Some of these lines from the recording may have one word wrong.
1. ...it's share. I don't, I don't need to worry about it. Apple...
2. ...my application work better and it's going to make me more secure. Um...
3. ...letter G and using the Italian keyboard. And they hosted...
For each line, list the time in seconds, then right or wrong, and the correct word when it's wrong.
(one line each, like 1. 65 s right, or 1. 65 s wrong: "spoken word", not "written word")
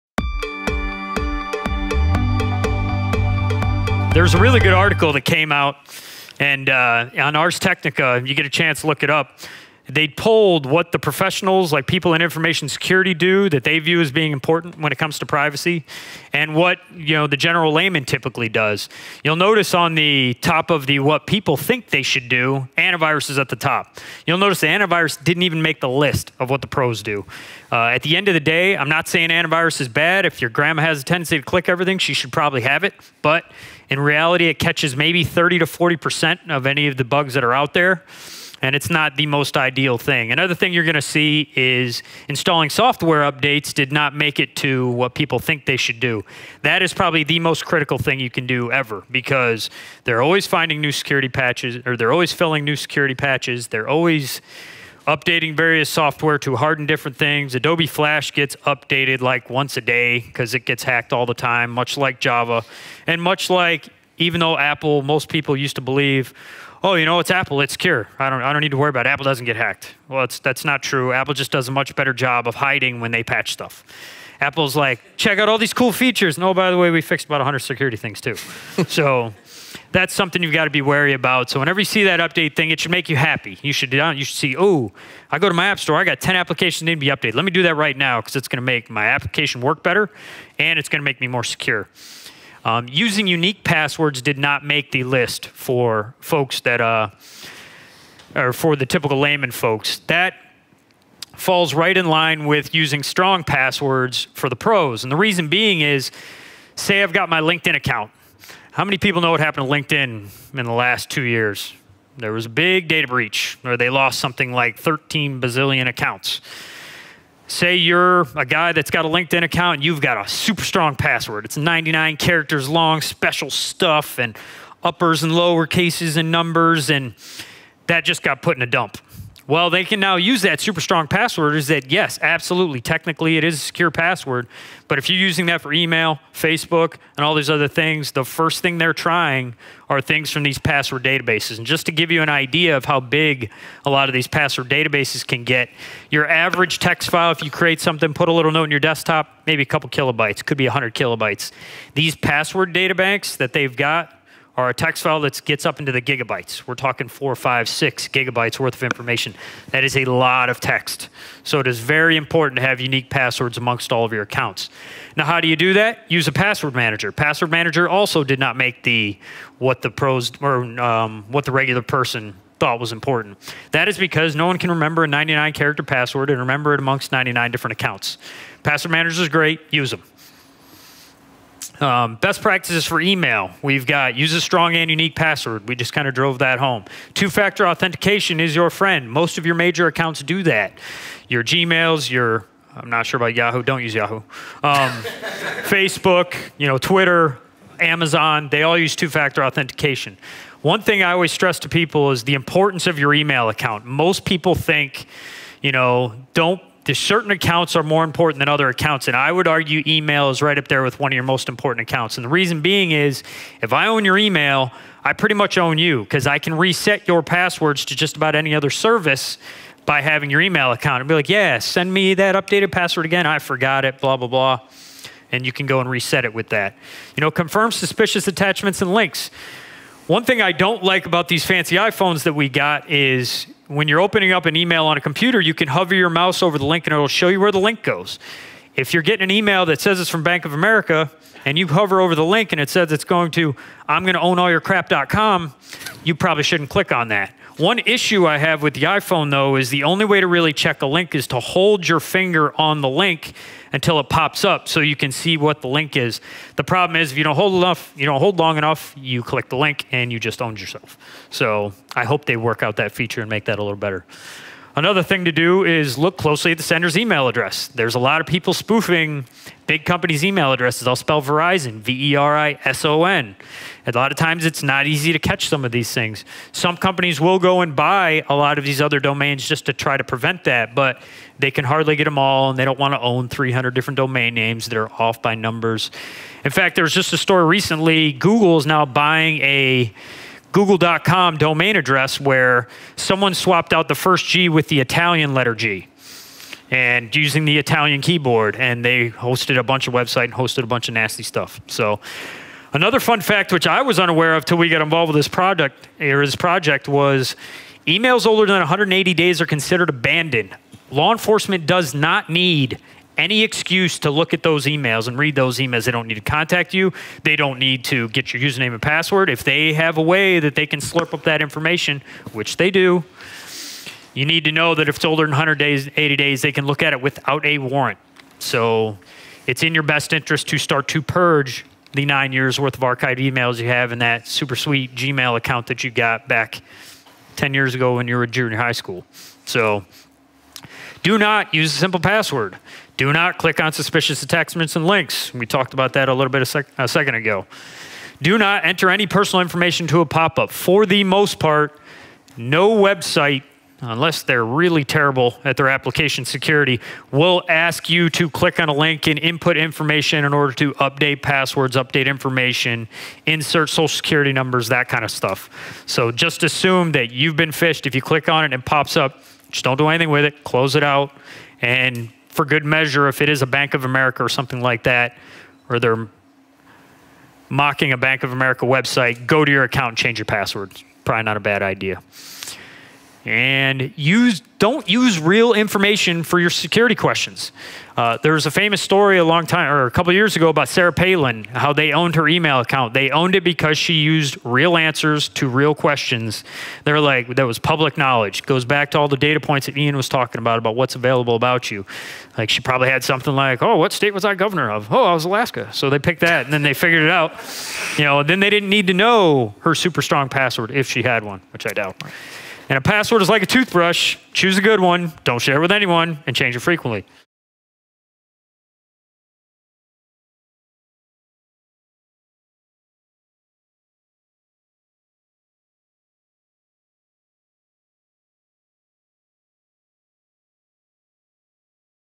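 1. 67 s wrong: "secure", not "share"
2. 88 s right
3. 295 s right.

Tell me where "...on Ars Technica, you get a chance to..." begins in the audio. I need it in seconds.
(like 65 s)
7 s.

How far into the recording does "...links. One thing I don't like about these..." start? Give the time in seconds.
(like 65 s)
228 s.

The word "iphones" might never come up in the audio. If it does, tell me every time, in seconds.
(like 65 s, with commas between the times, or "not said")
231 s, 248 s.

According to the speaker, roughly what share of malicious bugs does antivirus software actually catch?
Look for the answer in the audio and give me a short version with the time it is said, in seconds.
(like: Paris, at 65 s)
30 to 40%, at 35 s.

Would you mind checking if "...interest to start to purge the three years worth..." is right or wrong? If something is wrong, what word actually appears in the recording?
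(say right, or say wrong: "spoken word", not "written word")
wrong: "nine", not "three".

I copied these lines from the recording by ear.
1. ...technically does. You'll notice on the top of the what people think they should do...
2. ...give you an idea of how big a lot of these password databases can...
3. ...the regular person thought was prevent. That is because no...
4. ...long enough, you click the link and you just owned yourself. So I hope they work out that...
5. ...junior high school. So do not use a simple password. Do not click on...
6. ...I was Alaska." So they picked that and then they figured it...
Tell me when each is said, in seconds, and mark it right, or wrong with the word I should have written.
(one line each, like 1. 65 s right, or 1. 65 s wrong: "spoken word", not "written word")
1. 18 s wrong: "typically", not "technically"
2. 141 s right
3. 171 s wrong: "important", not "prevent"
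4. 258 s right
5. 338 s right
6. 405 s right.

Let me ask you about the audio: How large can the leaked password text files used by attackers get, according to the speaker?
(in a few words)
4, 5, 6 gigabytes.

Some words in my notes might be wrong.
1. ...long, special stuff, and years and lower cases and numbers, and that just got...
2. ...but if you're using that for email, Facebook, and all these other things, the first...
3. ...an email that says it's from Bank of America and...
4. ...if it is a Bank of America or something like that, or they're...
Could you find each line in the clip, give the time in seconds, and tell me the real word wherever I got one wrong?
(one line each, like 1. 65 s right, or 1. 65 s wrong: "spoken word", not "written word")
1. 122 s wrong: "uppers", not "years"
2. 134 s right
3. 239 s right
4. 373 s right.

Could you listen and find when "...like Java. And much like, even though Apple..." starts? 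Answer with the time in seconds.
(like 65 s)
61 s.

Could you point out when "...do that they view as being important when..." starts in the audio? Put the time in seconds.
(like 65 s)
13 s.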